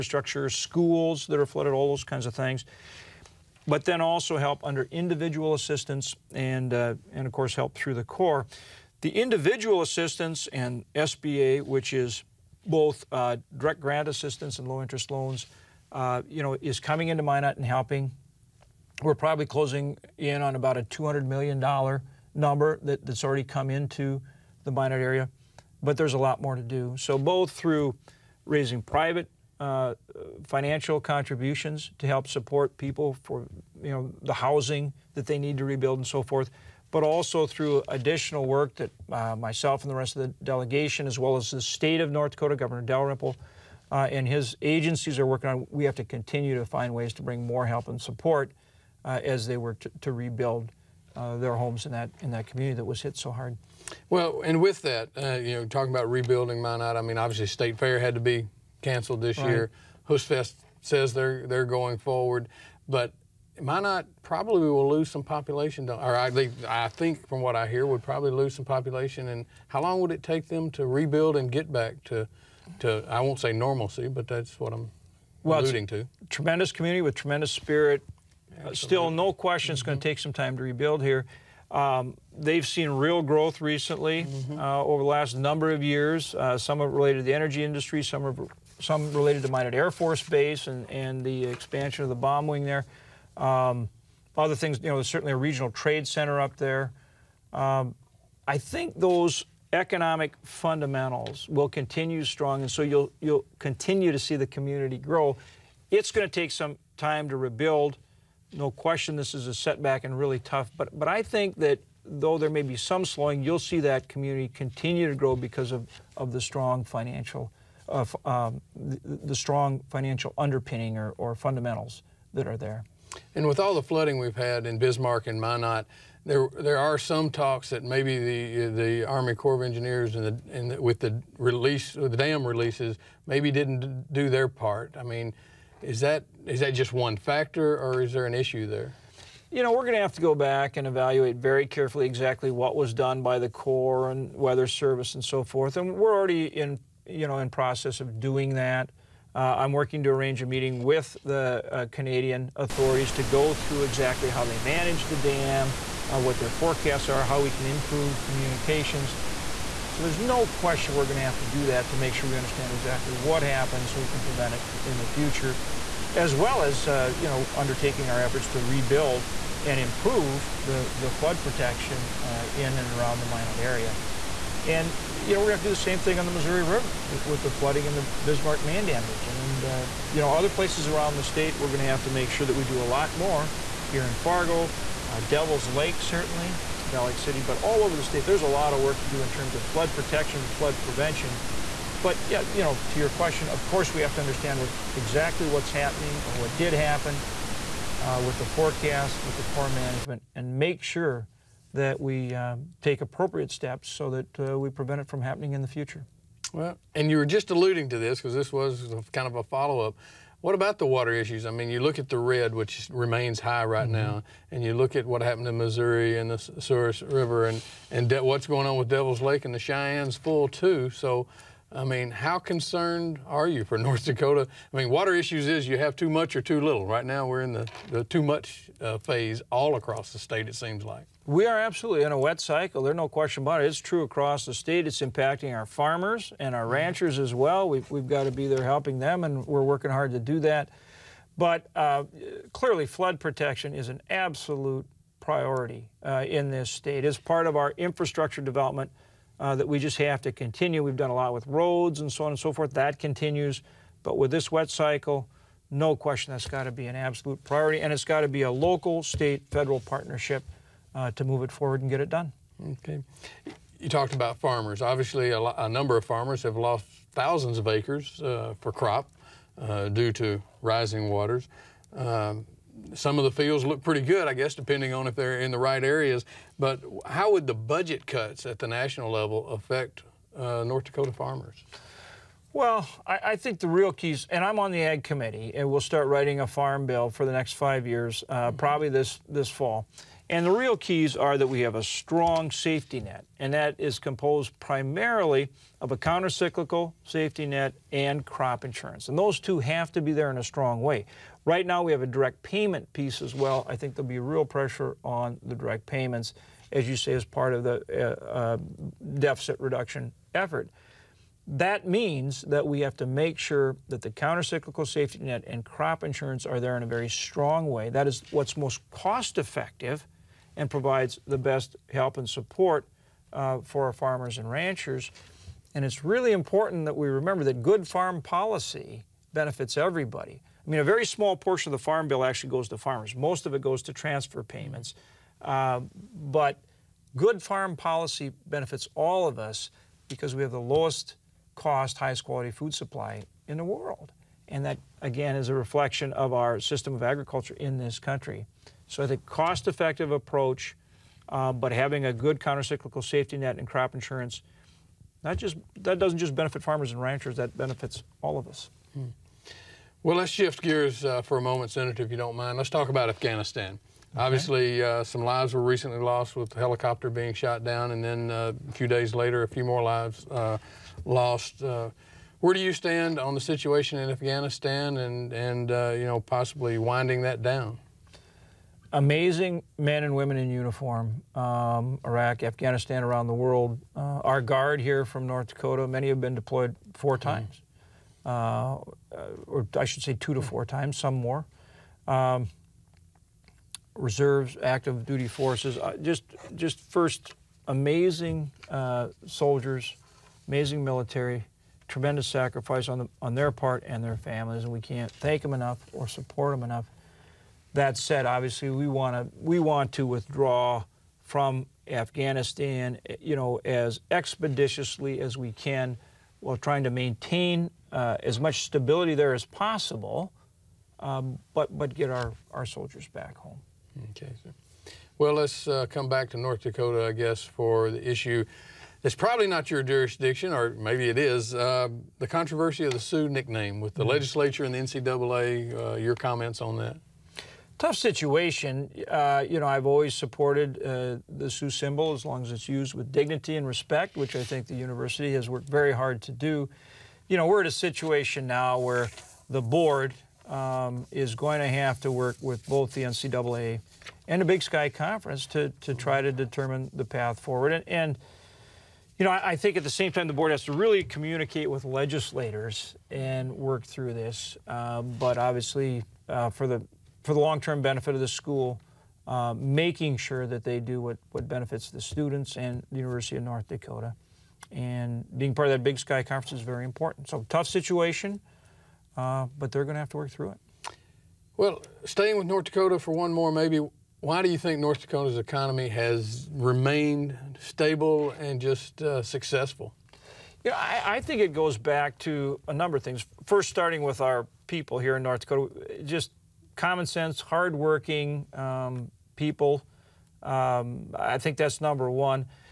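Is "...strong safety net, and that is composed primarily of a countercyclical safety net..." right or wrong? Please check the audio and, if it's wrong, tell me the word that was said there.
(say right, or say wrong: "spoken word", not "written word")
right.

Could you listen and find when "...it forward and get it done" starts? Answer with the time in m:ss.
4:21.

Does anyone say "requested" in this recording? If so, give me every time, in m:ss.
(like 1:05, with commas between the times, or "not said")
not said.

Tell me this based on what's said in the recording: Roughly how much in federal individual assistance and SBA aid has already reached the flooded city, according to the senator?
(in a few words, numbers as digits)
$200 million.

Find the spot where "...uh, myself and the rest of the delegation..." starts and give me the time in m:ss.
0:39.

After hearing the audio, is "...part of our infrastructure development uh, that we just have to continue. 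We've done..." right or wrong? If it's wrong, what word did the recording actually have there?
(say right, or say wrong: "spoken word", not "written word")
right.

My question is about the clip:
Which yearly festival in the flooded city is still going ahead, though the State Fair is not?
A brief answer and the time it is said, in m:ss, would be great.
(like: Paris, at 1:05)
Høstfest, at 1:00.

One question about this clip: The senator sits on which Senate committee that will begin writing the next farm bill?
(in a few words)
Ag committee.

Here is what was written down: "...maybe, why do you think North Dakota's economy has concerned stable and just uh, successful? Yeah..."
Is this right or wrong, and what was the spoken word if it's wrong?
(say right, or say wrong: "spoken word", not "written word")
wrong: "remained", not "concerned".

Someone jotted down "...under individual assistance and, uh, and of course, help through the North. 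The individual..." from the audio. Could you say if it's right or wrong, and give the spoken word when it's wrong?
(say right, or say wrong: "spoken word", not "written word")
wrong: "Corps", not "North".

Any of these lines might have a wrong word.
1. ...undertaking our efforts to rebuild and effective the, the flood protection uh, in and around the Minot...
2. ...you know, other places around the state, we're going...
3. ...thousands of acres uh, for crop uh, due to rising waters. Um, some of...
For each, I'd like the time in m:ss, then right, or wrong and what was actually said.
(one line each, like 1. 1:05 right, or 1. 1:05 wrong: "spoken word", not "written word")
1. 2:47 wrong: "improve", not "effective"
2. 3:00 right
3. 4:27 right.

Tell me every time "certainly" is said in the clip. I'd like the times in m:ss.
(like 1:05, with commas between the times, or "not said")
1:35, 3:06.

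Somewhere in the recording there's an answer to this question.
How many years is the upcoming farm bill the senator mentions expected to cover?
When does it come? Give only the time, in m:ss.
4:47.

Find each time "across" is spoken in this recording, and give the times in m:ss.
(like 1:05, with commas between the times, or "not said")
3:49, 3:54.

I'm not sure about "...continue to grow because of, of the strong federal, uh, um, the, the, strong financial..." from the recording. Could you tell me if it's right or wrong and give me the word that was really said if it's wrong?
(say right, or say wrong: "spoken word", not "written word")
wrong: "financial", not "federal".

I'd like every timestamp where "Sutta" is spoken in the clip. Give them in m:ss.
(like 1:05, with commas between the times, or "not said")
not said.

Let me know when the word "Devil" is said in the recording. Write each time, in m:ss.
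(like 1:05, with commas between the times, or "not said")
3:05, 3:38.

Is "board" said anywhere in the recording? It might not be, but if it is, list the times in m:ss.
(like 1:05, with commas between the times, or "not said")
7:29, 7:40.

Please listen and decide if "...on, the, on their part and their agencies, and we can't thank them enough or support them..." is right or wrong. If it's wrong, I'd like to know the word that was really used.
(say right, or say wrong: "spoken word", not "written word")
wrong: "families", not "agencies".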